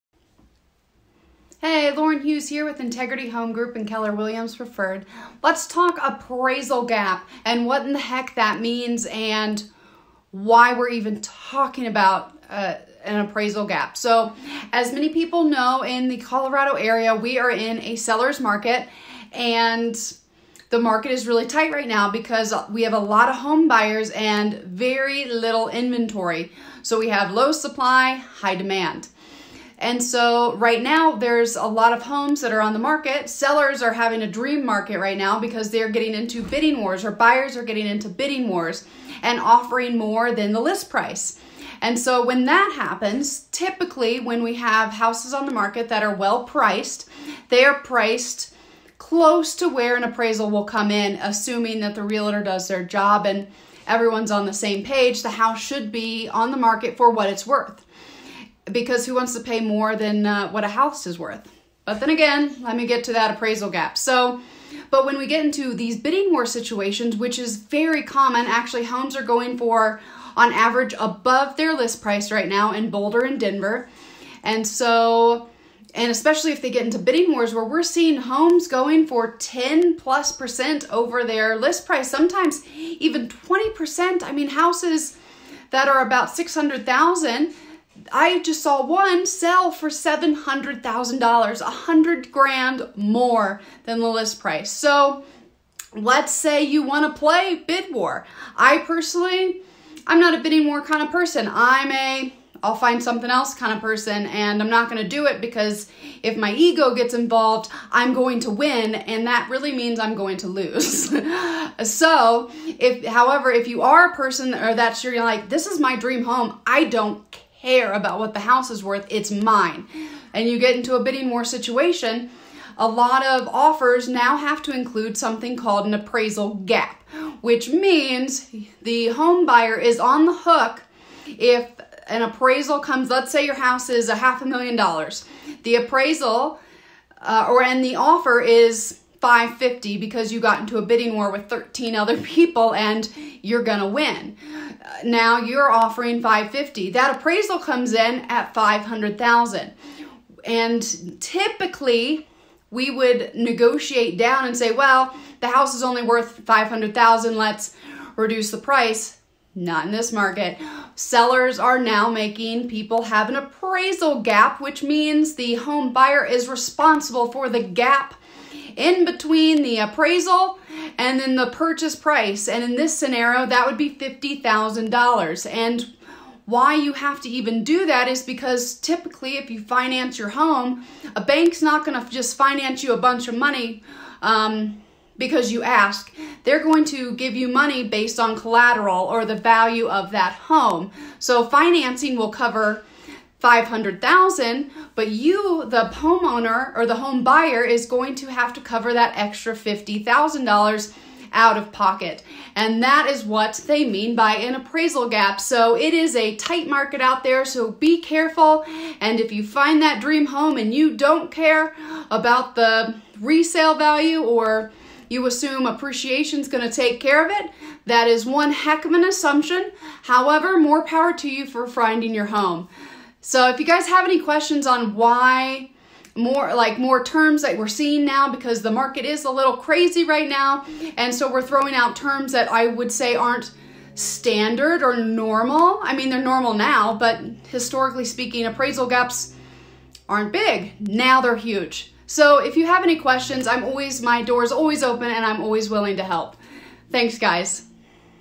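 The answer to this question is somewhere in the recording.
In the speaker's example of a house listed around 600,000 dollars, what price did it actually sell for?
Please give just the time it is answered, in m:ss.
1:29.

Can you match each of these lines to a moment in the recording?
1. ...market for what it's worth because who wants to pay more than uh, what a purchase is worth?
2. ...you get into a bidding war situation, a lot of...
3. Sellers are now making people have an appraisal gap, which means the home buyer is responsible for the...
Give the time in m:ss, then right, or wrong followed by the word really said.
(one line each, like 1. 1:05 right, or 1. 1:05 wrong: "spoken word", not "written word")
1. 0:56 wrong: "house", not "purchase"
2. 2:00 right
3. 2:40 right.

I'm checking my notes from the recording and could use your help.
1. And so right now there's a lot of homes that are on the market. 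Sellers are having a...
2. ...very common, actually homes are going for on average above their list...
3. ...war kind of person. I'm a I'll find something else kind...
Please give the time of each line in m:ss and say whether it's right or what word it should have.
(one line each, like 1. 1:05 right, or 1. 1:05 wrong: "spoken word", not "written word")
1. 0:29 right
2. 1:07 right
3. 1:40 right.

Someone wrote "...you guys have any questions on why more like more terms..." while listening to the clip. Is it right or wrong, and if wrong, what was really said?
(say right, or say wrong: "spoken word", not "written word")
right.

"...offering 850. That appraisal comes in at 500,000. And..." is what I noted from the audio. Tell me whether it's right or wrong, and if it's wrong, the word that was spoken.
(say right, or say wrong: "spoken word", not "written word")
wrong: "550", not "850".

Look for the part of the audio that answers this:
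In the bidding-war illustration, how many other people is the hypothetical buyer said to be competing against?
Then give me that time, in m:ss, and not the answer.
2:21.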